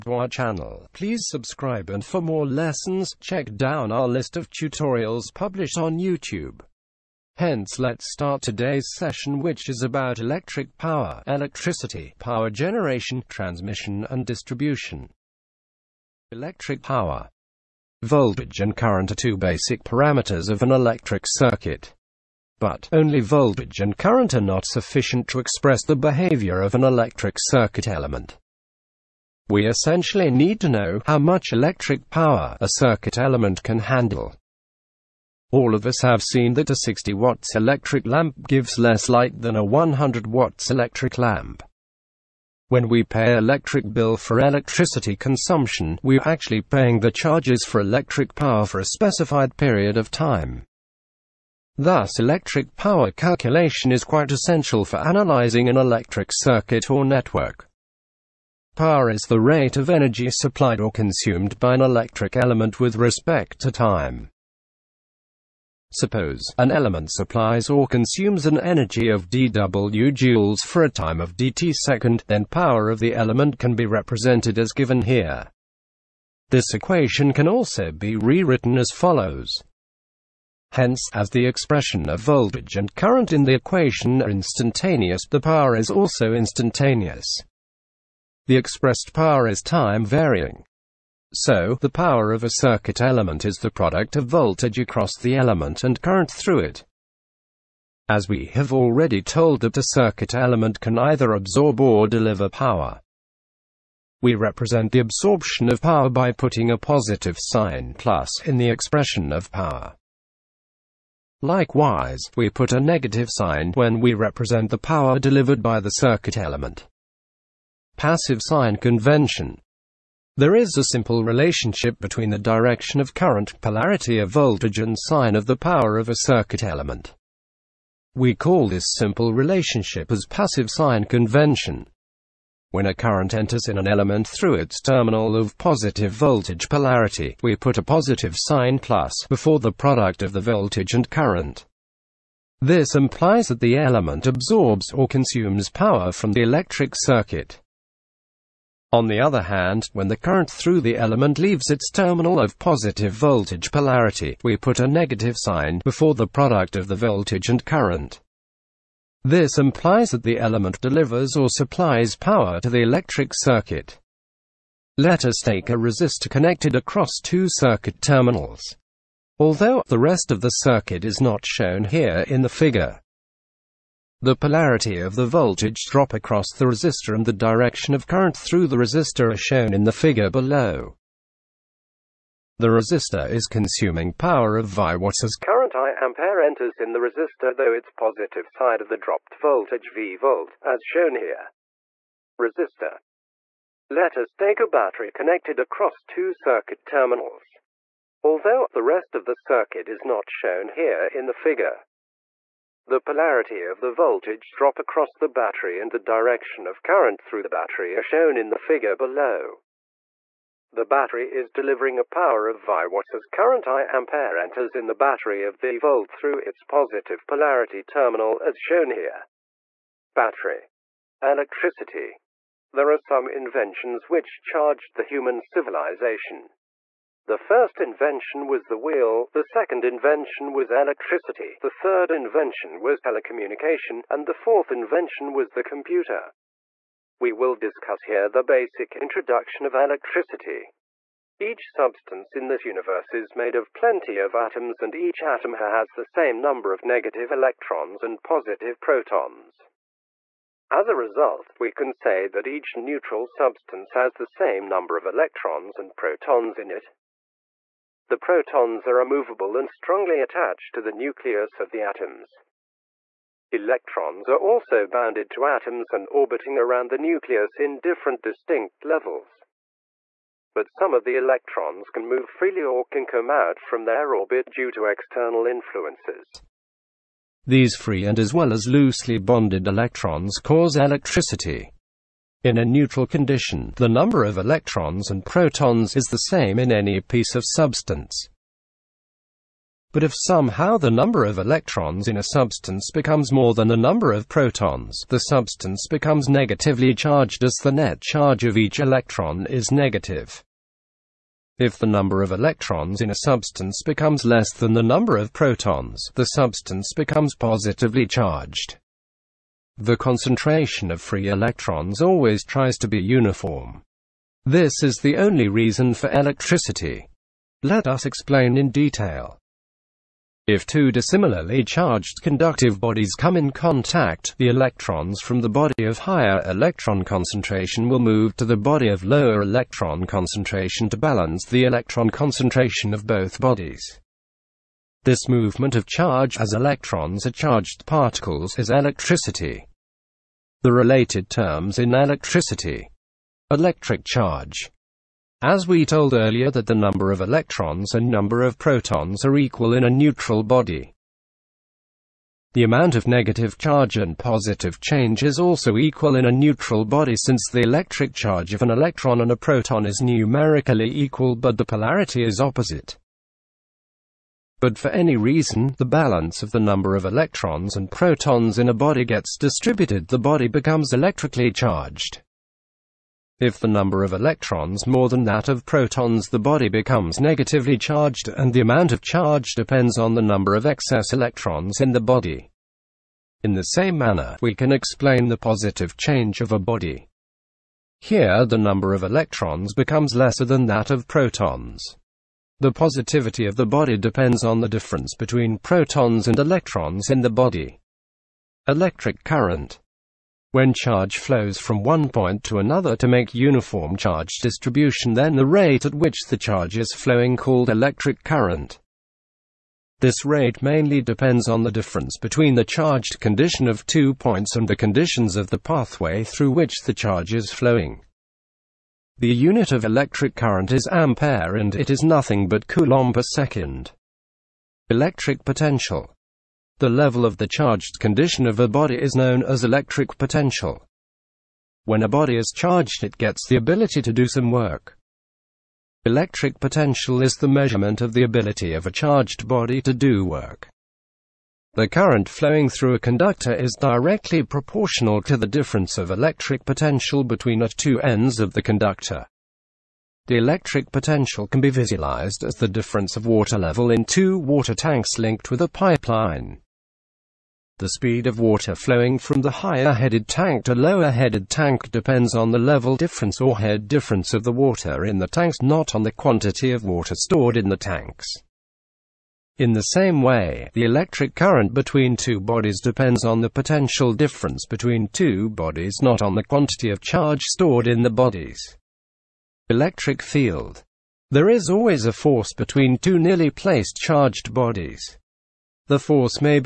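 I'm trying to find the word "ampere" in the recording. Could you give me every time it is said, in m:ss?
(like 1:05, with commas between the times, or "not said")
3:05, 3:33, 7:00.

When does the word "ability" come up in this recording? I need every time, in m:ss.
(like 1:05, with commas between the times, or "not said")
7:13, 7:18.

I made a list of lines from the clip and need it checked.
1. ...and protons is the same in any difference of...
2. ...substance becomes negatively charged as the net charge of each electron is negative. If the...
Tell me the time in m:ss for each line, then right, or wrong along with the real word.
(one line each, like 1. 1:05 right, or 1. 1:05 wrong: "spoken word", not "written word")
1. 4:45 wrong: "piece", not "difference"
2. 4:55 right.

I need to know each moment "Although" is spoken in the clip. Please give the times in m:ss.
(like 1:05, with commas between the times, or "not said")
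2:49, 3:18.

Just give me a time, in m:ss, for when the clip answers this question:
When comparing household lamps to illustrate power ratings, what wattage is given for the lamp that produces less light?
0:36.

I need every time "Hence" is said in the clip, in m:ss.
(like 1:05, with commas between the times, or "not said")
0:07, 1:20.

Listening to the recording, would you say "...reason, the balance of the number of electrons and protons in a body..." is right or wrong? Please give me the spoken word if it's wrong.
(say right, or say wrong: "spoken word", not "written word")
right.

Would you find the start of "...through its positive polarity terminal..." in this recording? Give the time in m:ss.
3:36.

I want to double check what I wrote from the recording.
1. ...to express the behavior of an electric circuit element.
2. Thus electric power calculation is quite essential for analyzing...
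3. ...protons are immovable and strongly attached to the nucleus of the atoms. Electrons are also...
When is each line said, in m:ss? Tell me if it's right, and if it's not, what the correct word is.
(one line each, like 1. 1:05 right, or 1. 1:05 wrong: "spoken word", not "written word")
1. 0:25 right
2. 0:51 right
3. 4:18 right.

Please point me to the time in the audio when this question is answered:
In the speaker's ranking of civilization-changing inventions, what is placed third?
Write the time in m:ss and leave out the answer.
3:52.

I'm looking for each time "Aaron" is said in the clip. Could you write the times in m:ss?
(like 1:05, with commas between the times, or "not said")
not said.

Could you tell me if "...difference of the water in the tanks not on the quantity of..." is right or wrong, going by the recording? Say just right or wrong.
right.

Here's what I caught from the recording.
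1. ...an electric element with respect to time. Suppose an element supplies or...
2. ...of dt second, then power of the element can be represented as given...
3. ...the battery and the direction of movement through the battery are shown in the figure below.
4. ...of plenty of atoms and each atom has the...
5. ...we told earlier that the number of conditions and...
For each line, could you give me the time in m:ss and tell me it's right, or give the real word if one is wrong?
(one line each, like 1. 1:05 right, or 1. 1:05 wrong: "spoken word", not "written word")
1. 1:01 right
2. 1:11 right
3. 3:25 wrong: "current", not "movement"
4. 4:03 right
5. 5:45 wrong: "electrons", not "conditions".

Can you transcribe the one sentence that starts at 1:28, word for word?
The expressed power is time varying.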